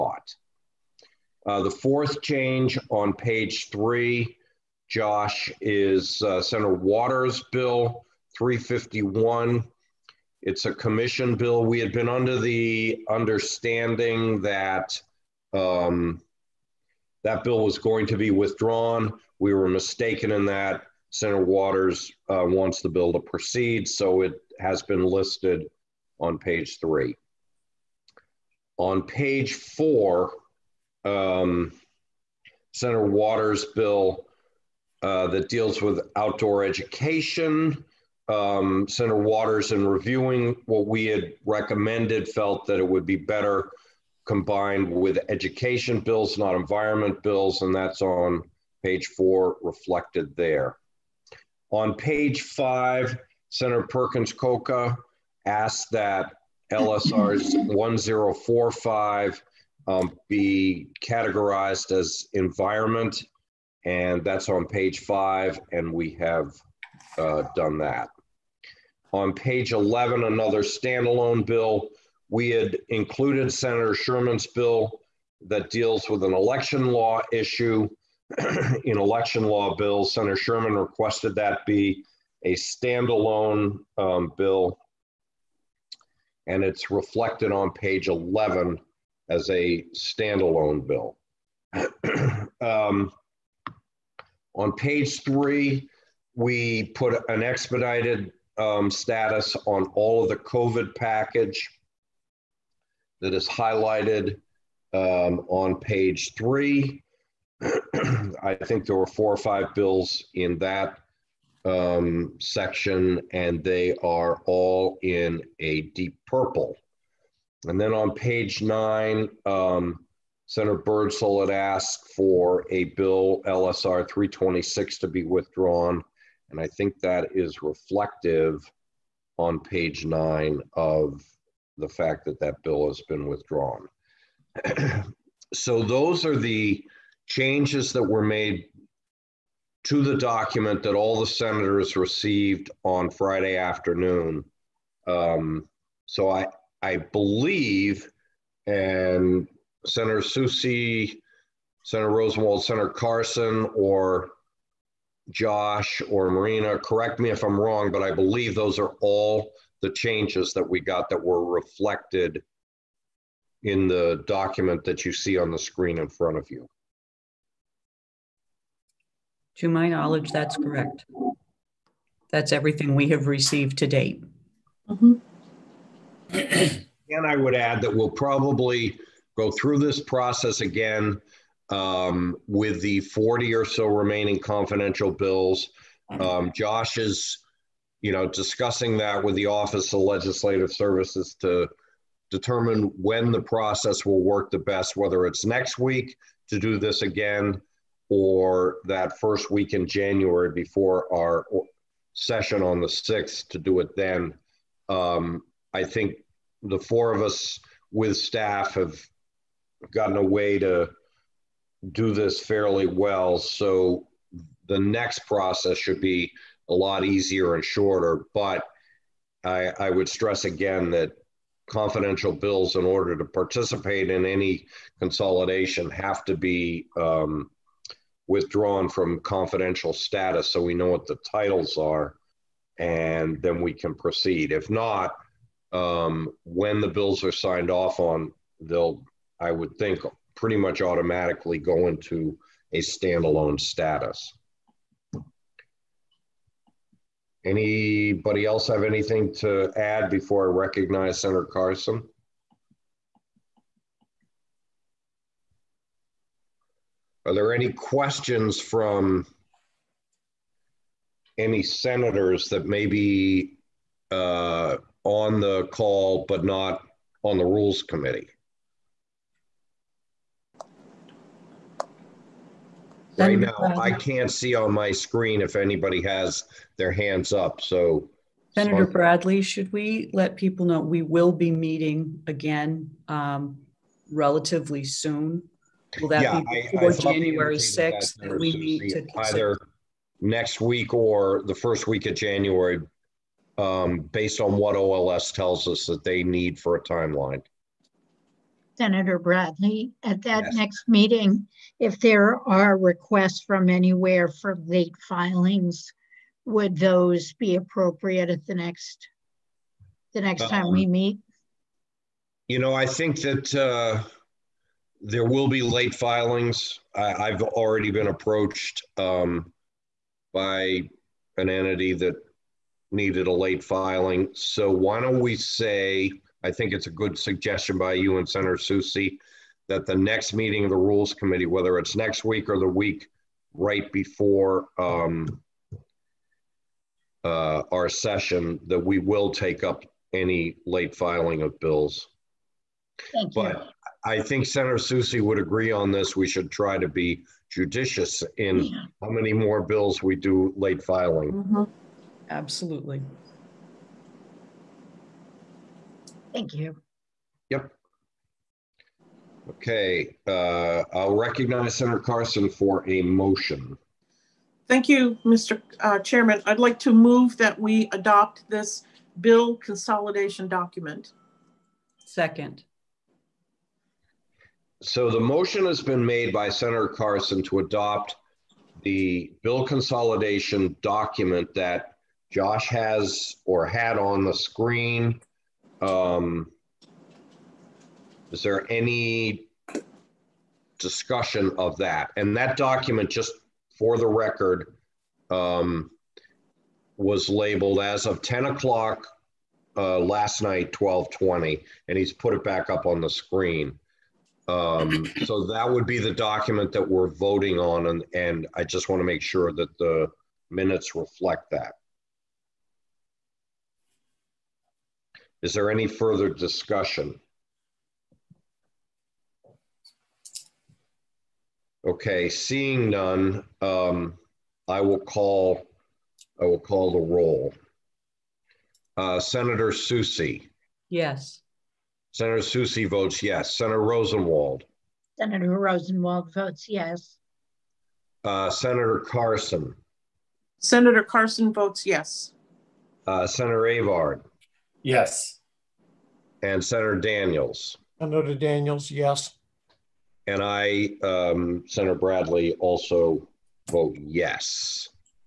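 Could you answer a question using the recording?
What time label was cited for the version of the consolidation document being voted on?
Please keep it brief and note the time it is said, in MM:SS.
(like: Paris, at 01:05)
10 o'clock, at 06:38.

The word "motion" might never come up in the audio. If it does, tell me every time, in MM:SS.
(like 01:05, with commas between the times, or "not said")
06:03, 06:15.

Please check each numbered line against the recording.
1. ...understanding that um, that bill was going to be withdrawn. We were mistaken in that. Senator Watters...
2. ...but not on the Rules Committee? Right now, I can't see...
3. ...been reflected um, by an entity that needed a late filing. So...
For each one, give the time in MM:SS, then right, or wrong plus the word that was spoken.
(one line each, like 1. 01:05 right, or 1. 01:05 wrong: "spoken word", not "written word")
1. 00:13 right
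2. 04:26 right
3. 05:17 wrong: "approached", not "reflected".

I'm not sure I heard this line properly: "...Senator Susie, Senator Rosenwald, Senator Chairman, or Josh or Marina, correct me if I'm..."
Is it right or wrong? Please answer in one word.
wrong.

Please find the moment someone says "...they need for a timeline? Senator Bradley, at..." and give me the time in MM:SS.
04:56.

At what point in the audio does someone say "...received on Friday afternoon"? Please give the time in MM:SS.
02:21.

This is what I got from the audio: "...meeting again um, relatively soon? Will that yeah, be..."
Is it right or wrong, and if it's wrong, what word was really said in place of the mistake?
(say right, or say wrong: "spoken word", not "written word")
right.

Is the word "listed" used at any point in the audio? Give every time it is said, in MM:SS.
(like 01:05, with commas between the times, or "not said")
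00:25.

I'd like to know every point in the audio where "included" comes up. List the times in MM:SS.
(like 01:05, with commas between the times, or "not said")
01:12.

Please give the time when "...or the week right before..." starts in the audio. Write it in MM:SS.
05:32.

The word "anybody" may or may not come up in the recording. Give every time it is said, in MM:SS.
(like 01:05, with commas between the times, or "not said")
04:07, 04:35.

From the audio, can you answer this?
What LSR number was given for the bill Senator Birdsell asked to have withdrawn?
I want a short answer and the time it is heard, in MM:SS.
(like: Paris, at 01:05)
326, at 02:03.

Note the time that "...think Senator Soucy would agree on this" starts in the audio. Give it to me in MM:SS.
05:44.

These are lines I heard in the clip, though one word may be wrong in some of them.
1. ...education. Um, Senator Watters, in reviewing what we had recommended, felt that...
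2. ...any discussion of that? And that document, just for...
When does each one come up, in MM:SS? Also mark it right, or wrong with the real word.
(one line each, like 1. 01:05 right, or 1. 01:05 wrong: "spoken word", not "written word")
1. 00:36 right
2. 06:28 right.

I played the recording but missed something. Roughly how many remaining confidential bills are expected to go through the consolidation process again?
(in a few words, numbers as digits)
40.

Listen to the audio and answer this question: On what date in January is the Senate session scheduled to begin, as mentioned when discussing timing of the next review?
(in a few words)
January 6th.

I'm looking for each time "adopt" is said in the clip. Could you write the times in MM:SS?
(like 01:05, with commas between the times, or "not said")
06:07, 06:17.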